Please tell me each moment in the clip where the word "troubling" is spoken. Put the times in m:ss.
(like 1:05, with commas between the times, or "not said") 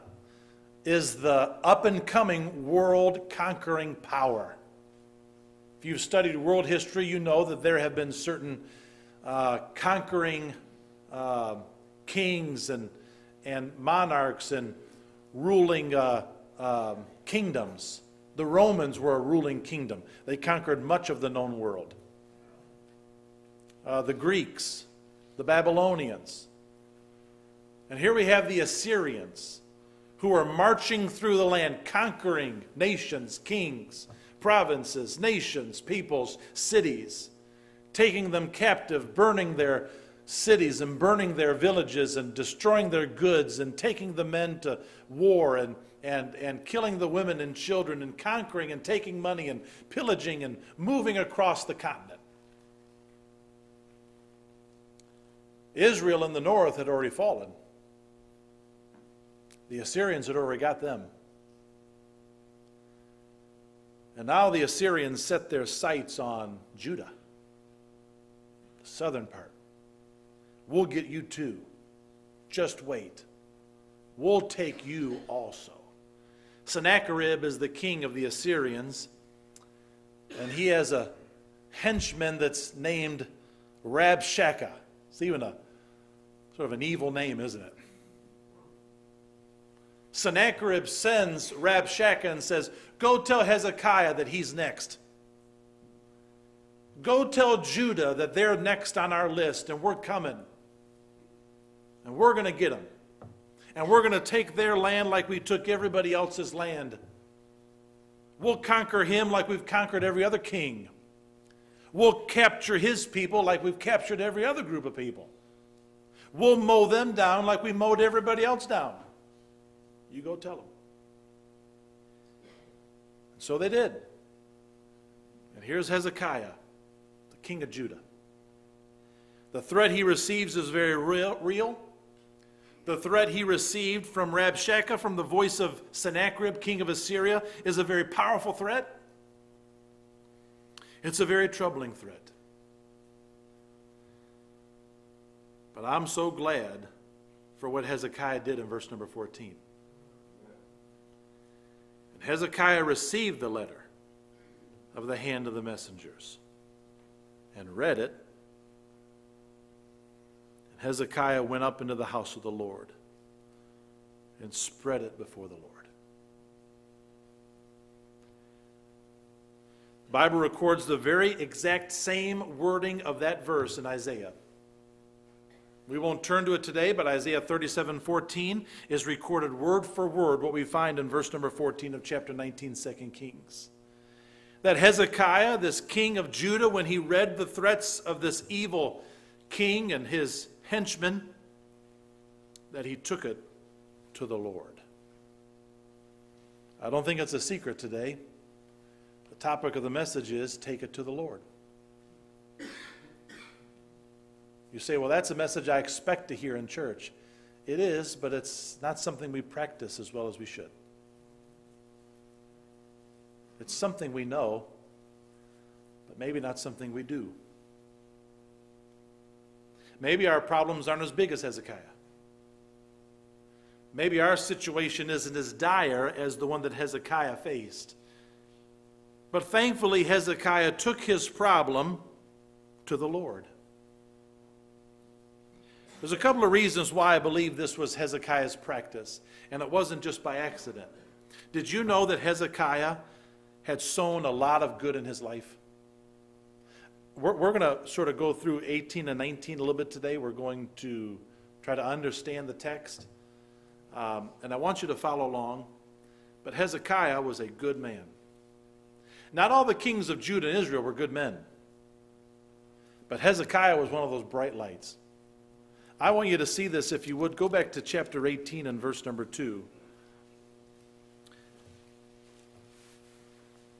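2:21.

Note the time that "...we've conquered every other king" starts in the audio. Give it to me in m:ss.
1:49.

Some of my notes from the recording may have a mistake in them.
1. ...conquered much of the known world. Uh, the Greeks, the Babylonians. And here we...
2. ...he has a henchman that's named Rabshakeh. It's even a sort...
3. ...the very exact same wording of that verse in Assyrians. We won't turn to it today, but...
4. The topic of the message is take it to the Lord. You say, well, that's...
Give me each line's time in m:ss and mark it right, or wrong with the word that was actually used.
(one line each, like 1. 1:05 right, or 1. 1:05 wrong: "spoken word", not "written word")
1. 0:20 right
2. 1:20 right
3. 2:50 wrong: "Isaiah", not "Assyrians"
4. 3:19 right.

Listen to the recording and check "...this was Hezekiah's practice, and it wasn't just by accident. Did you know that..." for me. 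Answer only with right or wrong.
right.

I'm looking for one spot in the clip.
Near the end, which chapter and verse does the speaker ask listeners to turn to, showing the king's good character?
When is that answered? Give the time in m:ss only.
4:27.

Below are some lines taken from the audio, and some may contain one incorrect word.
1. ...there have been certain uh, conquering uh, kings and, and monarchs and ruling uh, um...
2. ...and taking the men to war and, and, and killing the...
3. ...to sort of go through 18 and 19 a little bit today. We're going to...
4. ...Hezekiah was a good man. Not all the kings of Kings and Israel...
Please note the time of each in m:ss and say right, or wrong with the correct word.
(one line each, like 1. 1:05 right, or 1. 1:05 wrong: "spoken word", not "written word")
1. 0:07 right
2. 0:43 right
3. 4:07 right
4. 4:16 wrong: "Judah", not "Kings".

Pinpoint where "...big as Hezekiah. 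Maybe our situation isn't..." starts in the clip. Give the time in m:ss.
3:41.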